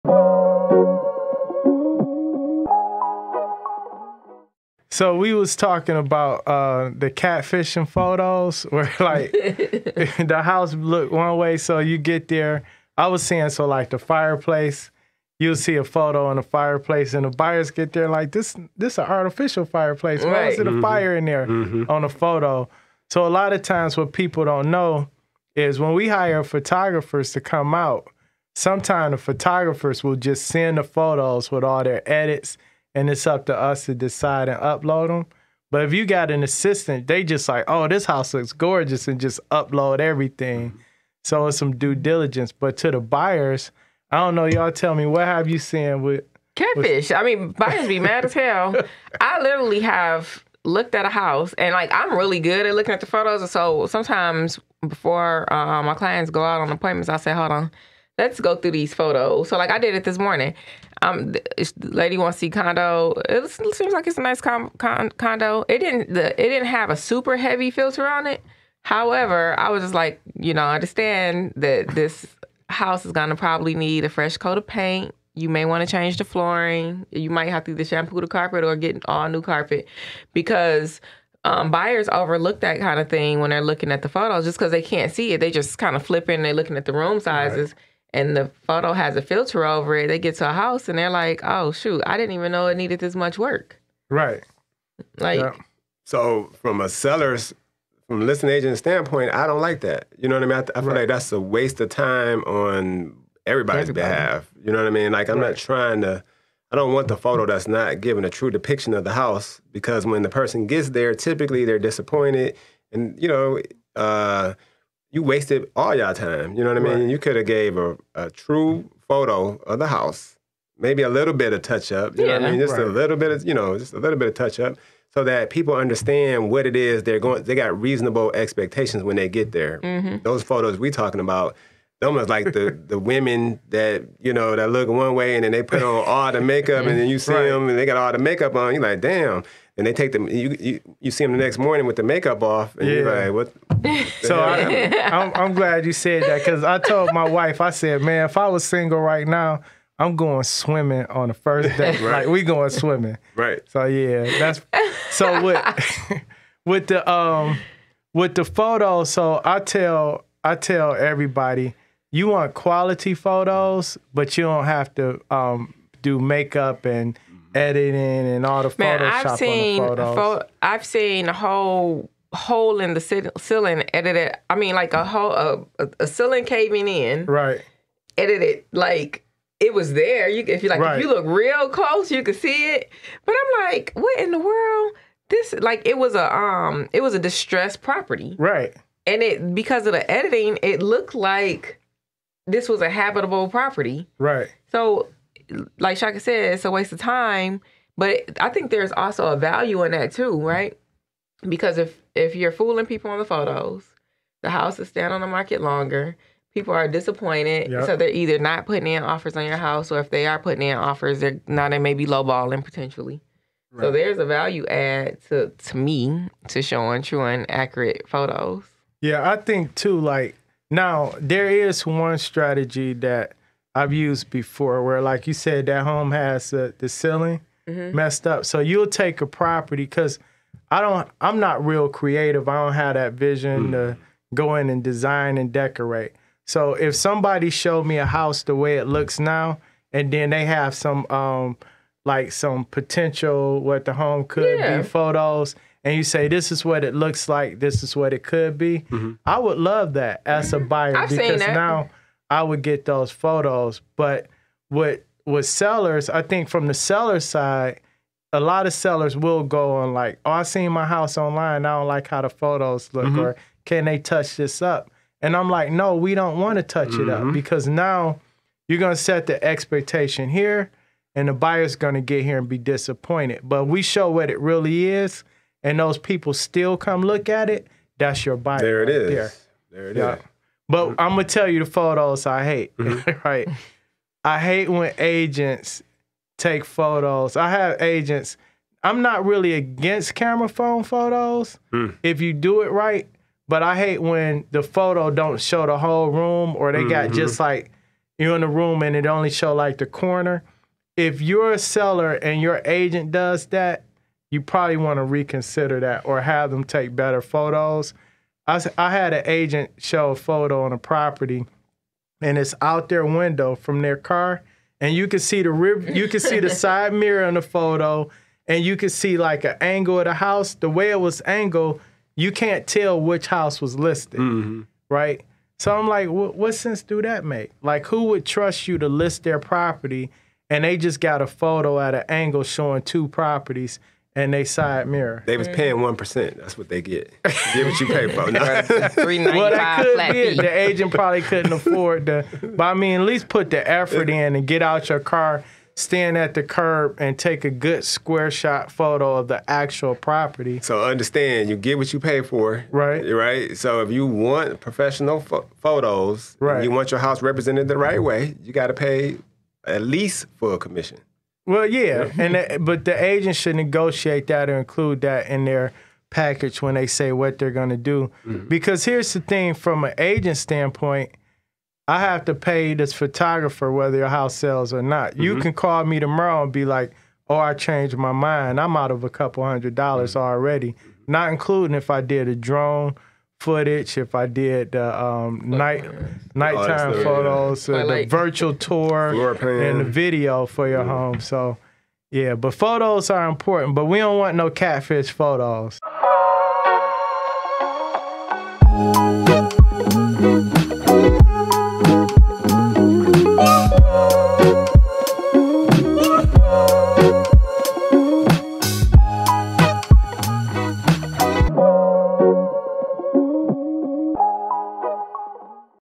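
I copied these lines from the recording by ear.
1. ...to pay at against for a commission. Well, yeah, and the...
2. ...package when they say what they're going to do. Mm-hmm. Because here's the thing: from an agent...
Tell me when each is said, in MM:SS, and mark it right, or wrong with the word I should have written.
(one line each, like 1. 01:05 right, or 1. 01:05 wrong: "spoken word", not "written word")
1. 05:58 wrong: "least", not "against"
2. 06:06 right.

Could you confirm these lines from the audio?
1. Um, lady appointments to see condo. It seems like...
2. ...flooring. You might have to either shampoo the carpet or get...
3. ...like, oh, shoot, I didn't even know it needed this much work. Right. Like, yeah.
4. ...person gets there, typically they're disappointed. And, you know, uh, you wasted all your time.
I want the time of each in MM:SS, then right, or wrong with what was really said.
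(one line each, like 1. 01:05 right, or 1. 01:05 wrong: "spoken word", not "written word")
1. 01:01 wrong: "wants", not "appointments"
2. 01:16 right
3. 01:31 right
4. 01:50 right.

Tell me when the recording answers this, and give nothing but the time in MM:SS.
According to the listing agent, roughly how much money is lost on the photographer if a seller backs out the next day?
06:19.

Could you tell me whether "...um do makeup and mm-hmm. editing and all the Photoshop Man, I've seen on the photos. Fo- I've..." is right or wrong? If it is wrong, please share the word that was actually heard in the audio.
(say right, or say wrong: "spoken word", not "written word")
right.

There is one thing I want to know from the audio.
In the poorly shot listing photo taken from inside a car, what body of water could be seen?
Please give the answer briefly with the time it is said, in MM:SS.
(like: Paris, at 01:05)
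the river, at 05:15.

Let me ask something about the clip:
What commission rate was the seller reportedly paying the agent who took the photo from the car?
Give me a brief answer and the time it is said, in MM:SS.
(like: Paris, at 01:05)
1%, at 05:35.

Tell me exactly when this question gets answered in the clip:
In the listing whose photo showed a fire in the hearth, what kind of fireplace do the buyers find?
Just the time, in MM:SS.
00:19.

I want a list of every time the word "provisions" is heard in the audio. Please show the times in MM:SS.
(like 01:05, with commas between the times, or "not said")
not said.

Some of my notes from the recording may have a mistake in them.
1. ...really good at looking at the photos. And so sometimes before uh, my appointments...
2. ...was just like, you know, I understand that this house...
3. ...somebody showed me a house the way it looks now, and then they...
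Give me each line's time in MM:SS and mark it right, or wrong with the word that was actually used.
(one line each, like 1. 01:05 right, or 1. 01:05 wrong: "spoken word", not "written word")
1. 00:52 wrong: "clients", not "appointments"
2. 01:09 right
3. 03:56 right.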